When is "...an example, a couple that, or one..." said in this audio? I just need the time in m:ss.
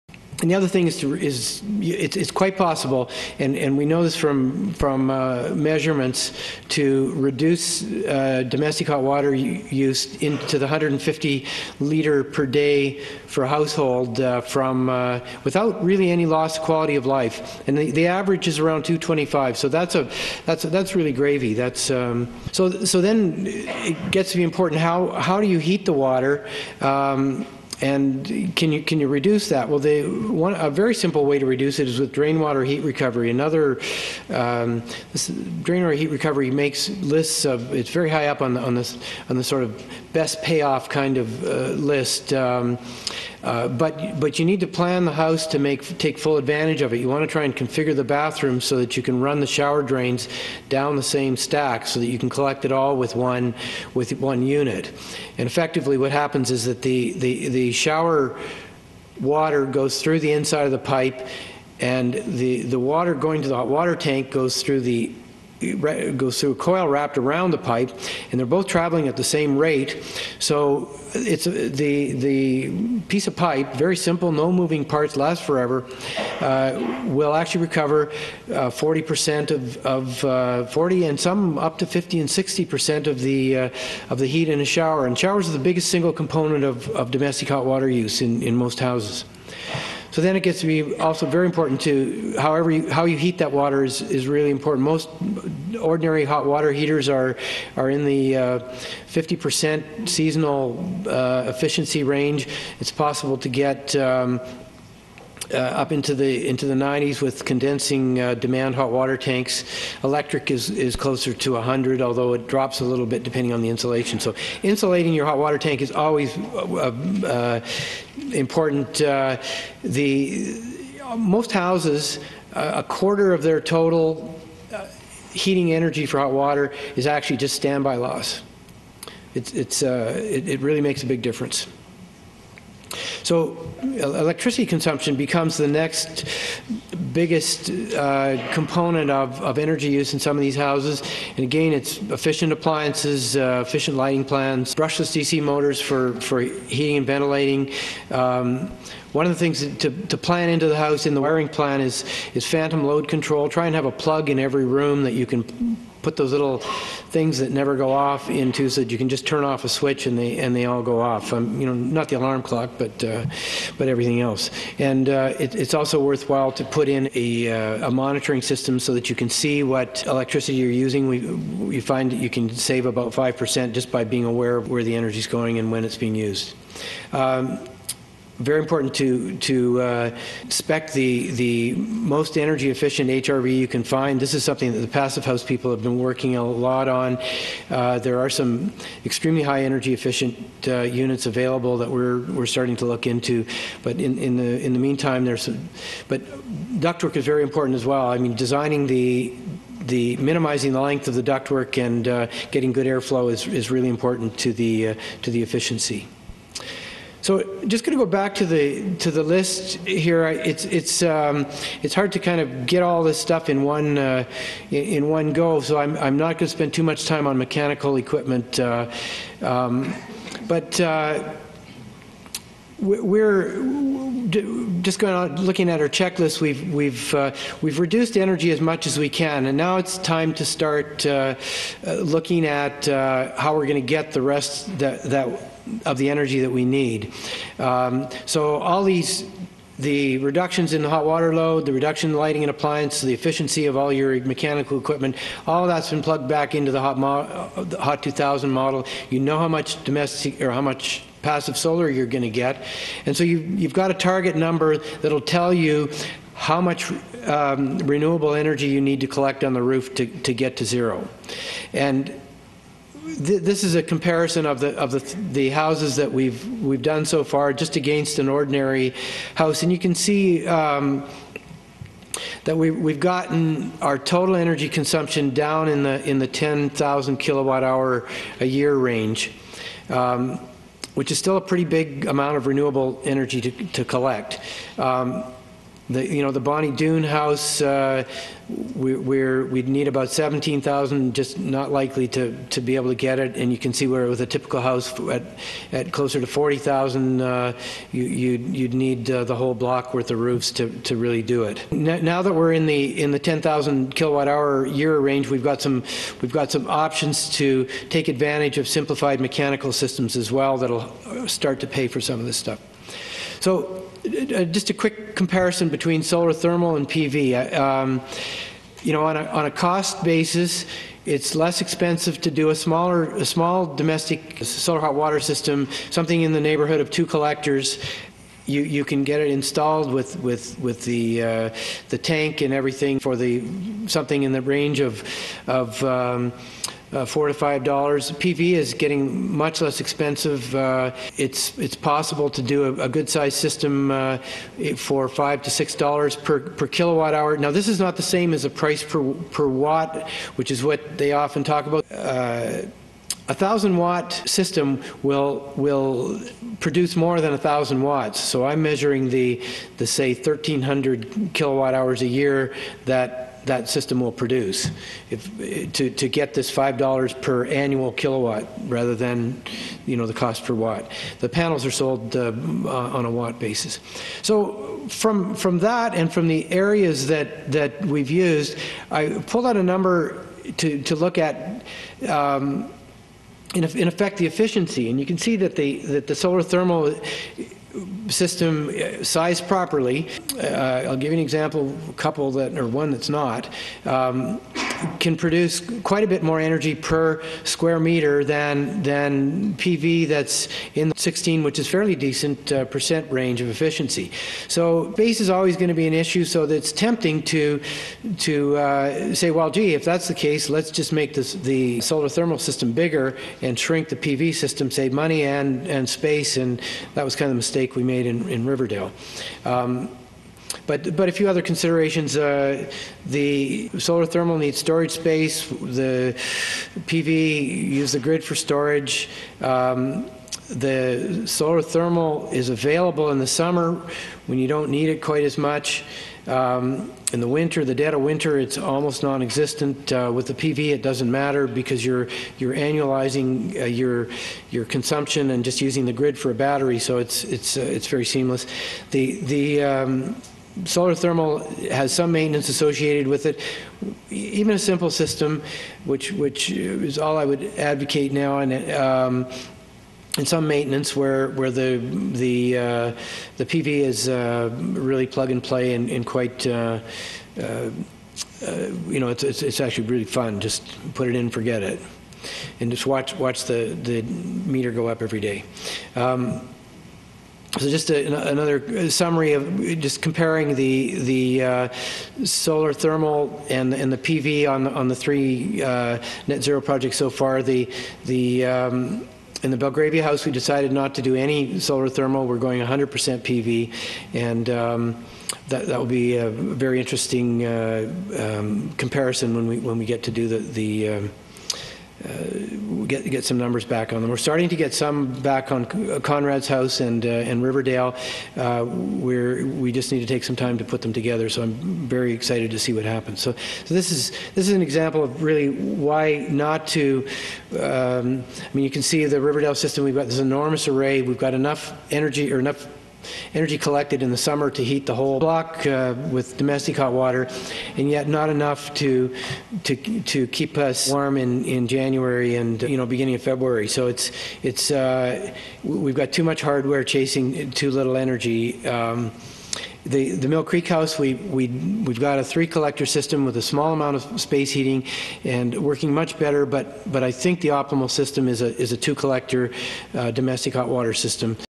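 6:31.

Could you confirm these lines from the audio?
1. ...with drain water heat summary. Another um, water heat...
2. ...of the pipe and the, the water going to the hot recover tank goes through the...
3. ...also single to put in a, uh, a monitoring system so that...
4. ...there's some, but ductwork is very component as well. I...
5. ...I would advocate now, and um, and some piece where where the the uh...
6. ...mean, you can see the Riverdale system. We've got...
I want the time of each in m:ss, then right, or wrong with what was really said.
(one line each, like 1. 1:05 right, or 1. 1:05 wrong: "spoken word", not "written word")
1. 0:31 wrong: "recovery", not "summary"
2. 1:00 wrong: "water", not "recover"
3. 2:45 wrong: "worthwhile", not "single"
4. 3:15 wrong: "important", not "component"
5. 7:37 wrong: "maintenance", not "piece"
6. 8:38 right.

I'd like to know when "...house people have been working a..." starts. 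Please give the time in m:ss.
3:05.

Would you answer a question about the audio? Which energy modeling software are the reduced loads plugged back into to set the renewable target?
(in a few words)
HOT2000.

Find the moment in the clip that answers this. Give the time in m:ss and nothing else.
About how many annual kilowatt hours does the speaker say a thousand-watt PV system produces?
6:00.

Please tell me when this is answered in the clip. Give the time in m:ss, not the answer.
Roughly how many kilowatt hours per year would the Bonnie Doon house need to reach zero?
4:50.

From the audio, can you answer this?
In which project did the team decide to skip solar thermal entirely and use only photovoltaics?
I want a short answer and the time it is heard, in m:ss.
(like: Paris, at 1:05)
Belgravia house, at 8:09.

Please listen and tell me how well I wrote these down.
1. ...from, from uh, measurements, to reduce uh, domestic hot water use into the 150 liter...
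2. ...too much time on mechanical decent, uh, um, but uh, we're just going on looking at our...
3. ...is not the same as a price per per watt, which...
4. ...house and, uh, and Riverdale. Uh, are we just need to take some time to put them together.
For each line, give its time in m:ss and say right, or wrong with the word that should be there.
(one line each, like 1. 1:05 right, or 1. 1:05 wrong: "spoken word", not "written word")
1. 0:04 right
2. 3:36 wrong: "equipment", not "decent"
3. 5:47 right
4. 8:26 right.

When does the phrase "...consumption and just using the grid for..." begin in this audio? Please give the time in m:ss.
7:24.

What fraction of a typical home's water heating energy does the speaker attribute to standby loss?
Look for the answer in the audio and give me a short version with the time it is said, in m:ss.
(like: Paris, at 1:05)
A quarter, at 2:02.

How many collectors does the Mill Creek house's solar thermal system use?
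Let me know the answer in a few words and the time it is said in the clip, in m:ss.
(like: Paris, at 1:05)
3, at 9:02.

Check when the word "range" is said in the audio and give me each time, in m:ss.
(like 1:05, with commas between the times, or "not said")
1:42, 4:38, 5:04, 5:34, 6:43.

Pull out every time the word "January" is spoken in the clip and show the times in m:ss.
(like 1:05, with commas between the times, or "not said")
8:51.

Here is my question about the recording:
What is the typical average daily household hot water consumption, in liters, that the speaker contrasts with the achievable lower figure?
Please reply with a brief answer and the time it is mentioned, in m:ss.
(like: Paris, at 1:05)
225, at 0:18.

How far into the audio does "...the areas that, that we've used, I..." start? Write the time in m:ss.
6:16.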